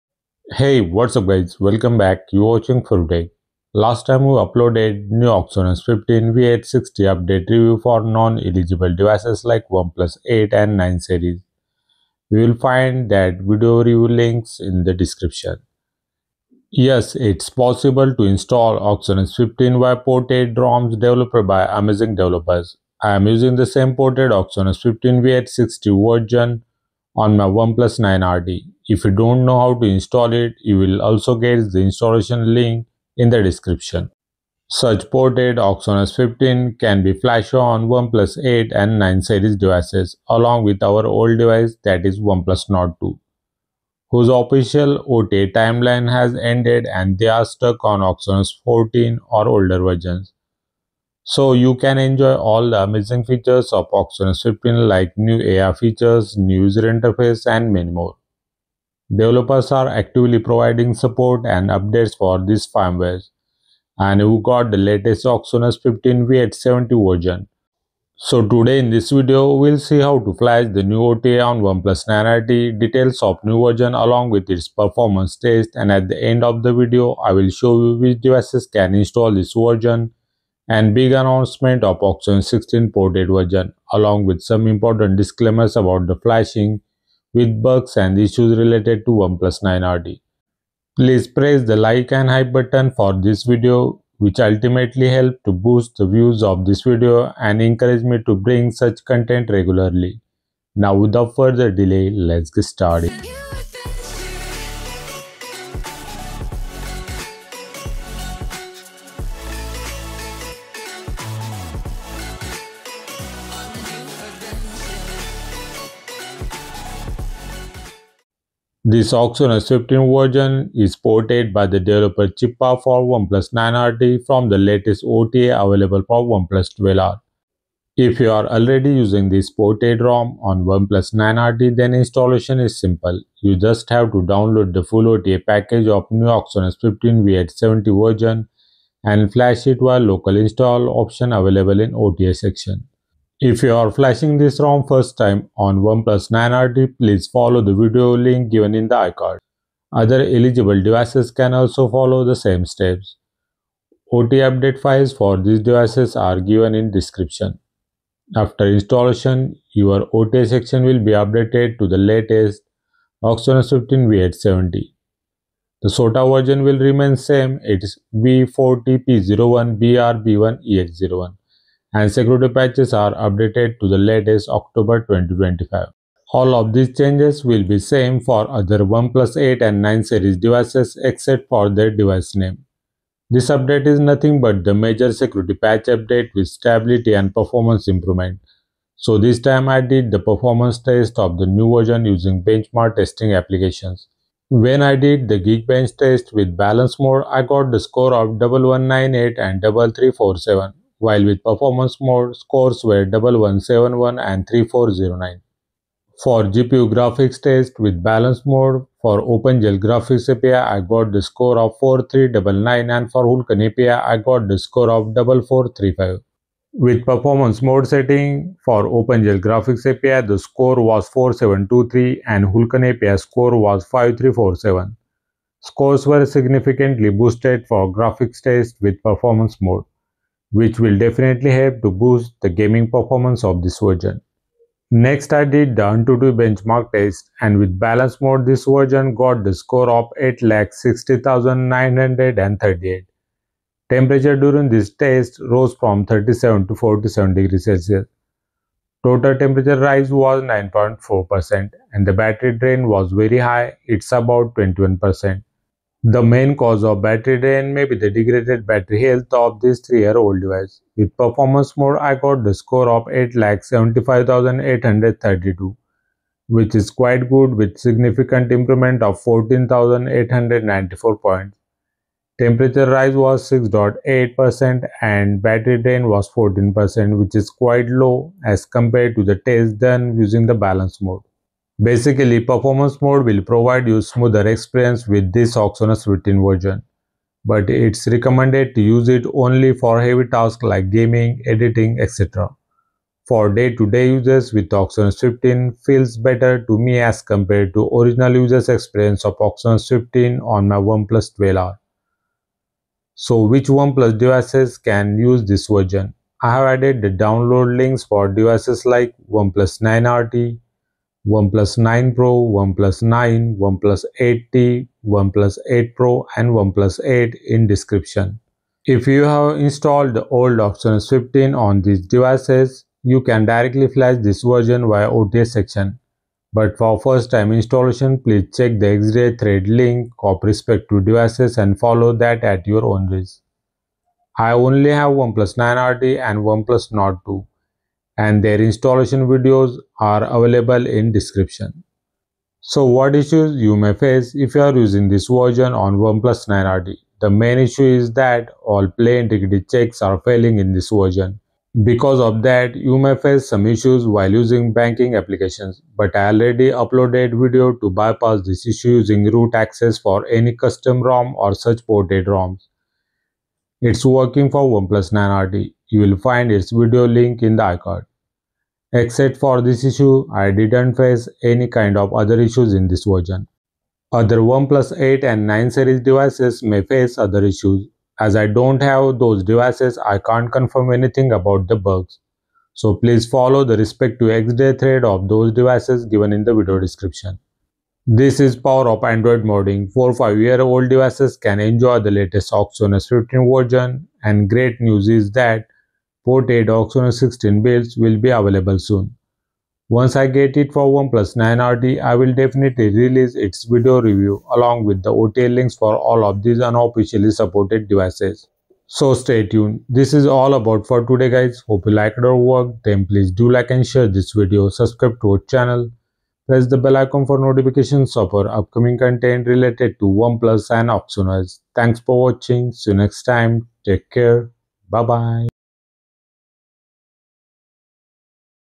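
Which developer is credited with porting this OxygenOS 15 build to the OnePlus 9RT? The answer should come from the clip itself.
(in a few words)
Chippa.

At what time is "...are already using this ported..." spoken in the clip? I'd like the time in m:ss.
2:08.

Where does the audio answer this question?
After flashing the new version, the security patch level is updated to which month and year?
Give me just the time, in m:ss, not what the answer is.
2:54.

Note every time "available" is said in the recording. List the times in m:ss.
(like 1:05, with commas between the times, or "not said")
2:05, 2:21, 5:40, 6:38.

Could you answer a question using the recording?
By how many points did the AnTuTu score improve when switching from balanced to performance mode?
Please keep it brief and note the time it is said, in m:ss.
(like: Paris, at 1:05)
14,894, at 4:29.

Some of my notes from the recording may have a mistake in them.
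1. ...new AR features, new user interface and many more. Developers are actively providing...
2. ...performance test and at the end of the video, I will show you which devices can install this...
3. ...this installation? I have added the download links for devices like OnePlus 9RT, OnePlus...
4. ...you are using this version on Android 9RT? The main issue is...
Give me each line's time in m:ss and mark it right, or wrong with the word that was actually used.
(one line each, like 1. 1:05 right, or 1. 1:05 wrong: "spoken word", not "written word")
1. 0:55 right
2. 1:14 right
3. 5:05 wrong: "version", not "installation"
4. 5:44 wrong: "OnePlus", not "Android".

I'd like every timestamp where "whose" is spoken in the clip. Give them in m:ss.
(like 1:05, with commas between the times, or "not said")
0:44.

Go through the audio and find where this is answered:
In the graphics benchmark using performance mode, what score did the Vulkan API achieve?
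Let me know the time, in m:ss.
3:43.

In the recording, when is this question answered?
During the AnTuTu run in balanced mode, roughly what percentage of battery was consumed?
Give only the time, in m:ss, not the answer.
4:14.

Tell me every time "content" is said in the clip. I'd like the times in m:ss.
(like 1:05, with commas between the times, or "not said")
1:39, 6:58.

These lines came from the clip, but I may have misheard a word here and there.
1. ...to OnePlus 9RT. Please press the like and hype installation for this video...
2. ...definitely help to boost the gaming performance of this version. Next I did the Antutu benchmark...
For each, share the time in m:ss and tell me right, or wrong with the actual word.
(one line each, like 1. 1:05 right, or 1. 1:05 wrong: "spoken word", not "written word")
1. 1:29 wrong: "button", not "installation"
2. 3:50 right.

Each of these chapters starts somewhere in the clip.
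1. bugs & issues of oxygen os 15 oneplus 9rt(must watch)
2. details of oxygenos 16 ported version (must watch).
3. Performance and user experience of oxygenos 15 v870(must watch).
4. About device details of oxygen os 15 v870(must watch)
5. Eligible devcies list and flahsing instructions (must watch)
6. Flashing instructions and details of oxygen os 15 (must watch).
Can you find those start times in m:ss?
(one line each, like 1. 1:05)
1. 5:42
2. 6:27
3. 3:03
4. 2:38
5. 5:02
6. 1:58.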